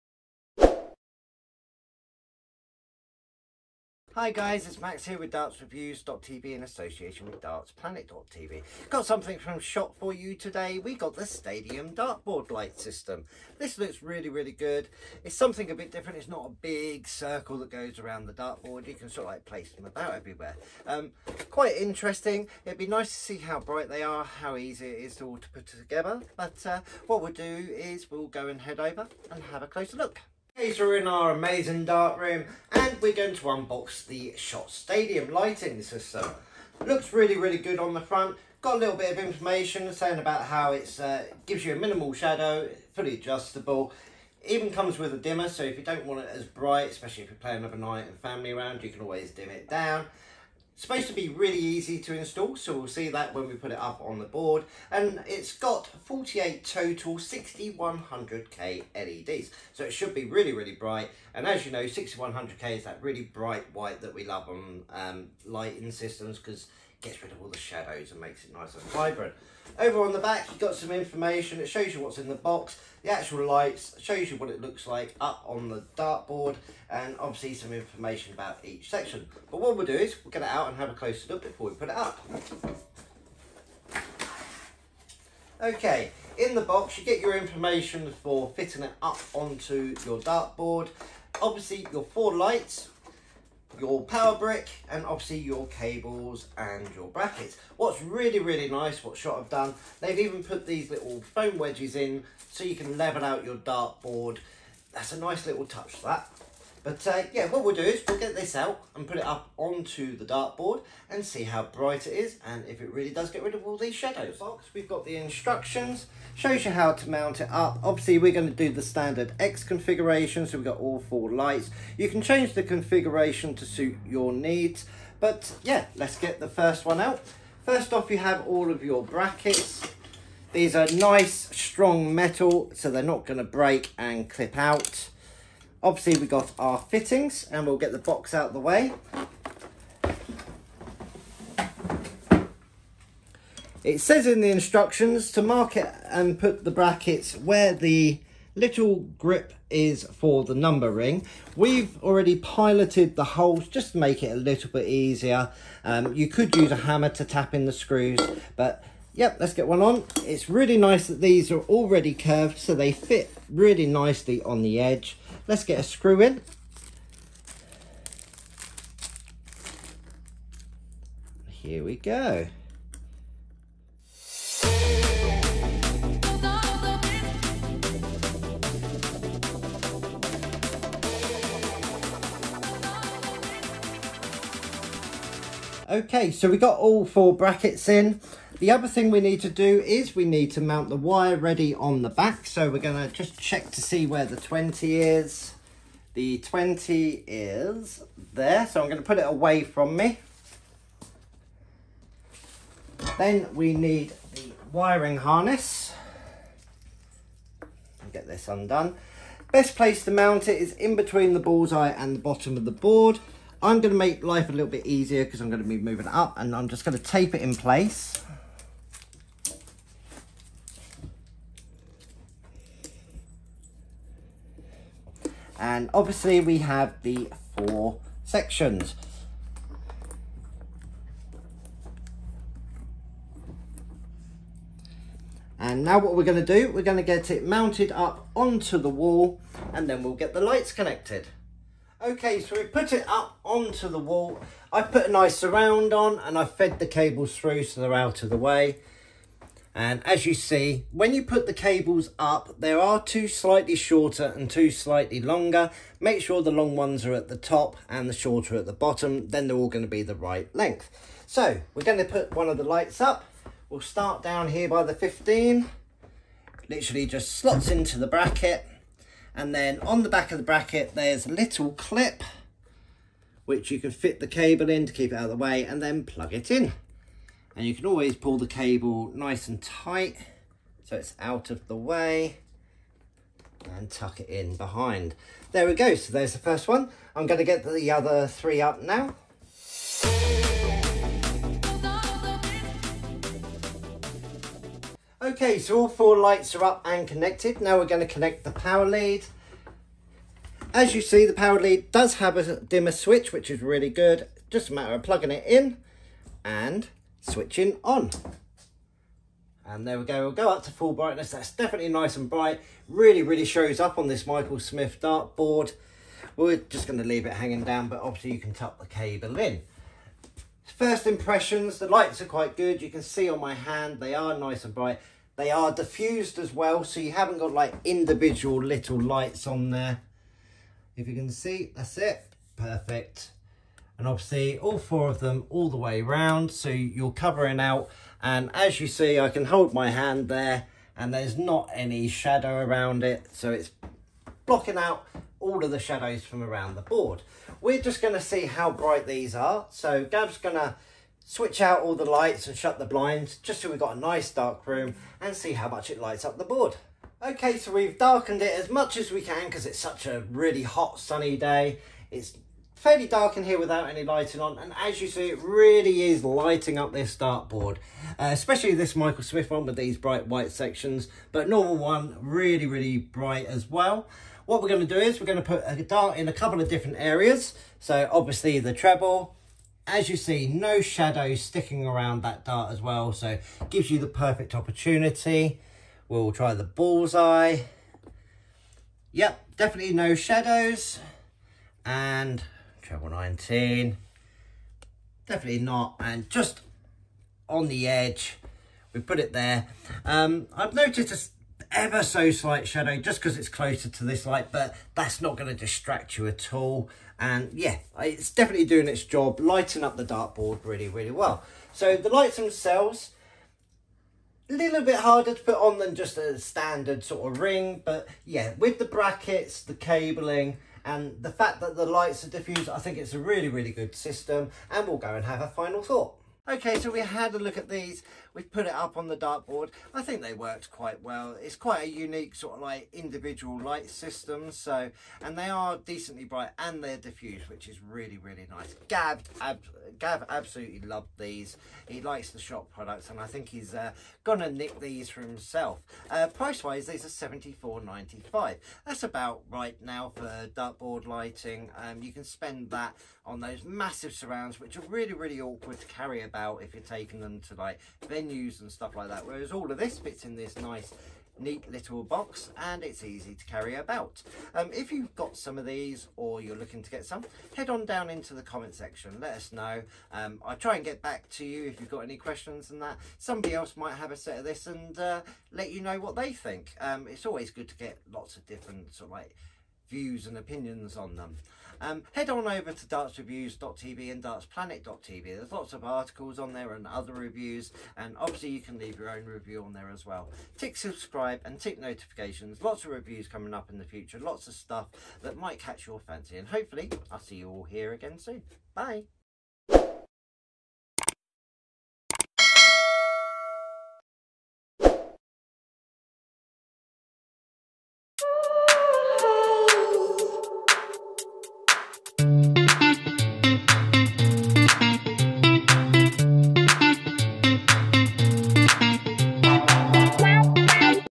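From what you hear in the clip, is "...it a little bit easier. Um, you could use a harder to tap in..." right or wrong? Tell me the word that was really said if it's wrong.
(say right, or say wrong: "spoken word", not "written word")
wrong: "hammer", not "harder".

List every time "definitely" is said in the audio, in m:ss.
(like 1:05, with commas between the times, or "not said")
5:11, 6:29, 6:35, 6:48.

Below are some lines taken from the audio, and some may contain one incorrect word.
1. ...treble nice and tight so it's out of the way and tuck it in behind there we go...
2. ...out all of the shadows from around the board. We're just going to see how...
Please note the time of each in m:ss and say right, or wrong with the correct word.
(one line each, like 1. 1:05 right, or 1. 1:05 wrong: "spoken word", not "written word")
1. 4:38 wrong: "cable", not "treble"
2. 5:44 right.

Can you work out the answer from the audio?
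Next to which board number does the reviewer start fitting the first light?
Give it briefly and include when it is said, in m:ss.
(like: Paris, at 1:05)
15, at 4:24.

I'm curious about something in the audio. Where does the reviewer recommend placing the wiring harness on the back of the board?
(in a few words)
between the bullseye and the bottom.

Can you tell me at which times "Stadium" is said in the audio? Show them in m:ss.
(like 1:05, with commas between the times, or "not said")
0:11, 0:34.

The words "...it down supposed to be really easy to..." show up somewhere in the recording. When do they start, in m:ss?
0:49.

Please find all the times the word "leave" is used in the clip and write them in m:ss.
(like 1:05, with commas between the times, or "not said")
5:17, 8:08.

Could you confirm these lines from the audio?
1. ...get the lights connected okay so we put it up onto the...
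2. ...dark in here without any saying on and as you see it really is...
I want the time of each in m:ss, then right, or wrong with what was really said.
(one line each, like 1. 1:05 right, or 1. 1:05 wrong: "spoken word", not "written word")
1. 4:00 right
2. 6:03 wrong: "lighting", not "saying".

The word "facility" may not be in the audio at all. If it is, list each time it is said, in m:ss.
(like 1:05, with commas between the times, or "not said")
not said.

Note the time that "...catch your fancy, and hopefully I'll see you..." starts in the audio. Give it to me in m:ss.
8:15.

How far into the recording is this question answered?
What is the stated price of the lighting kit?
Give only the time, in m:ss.
7:27.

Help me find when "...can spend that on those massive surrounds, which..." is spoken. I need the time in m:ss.
7:32.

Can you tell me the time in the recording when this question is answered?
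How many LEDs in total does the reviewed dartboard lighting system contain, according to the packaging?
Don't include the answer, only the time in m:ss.
0:55.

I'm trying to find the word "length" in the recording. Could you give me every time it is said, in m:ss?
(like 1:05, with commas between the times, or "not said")
4:20.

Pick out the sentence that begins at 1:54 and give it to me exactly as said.
Box, we've got the instructions, shows you how to mount it up.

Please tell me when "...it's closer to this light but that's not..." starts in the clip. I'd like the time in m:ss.
6:43.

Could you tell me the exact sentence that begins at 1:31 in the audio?
Obviously, your four lights, your power brick and obviously your cables and your brackets.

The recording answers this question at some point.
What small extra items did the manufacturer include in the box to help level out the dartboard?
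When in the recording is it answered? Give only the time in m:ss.
1:41.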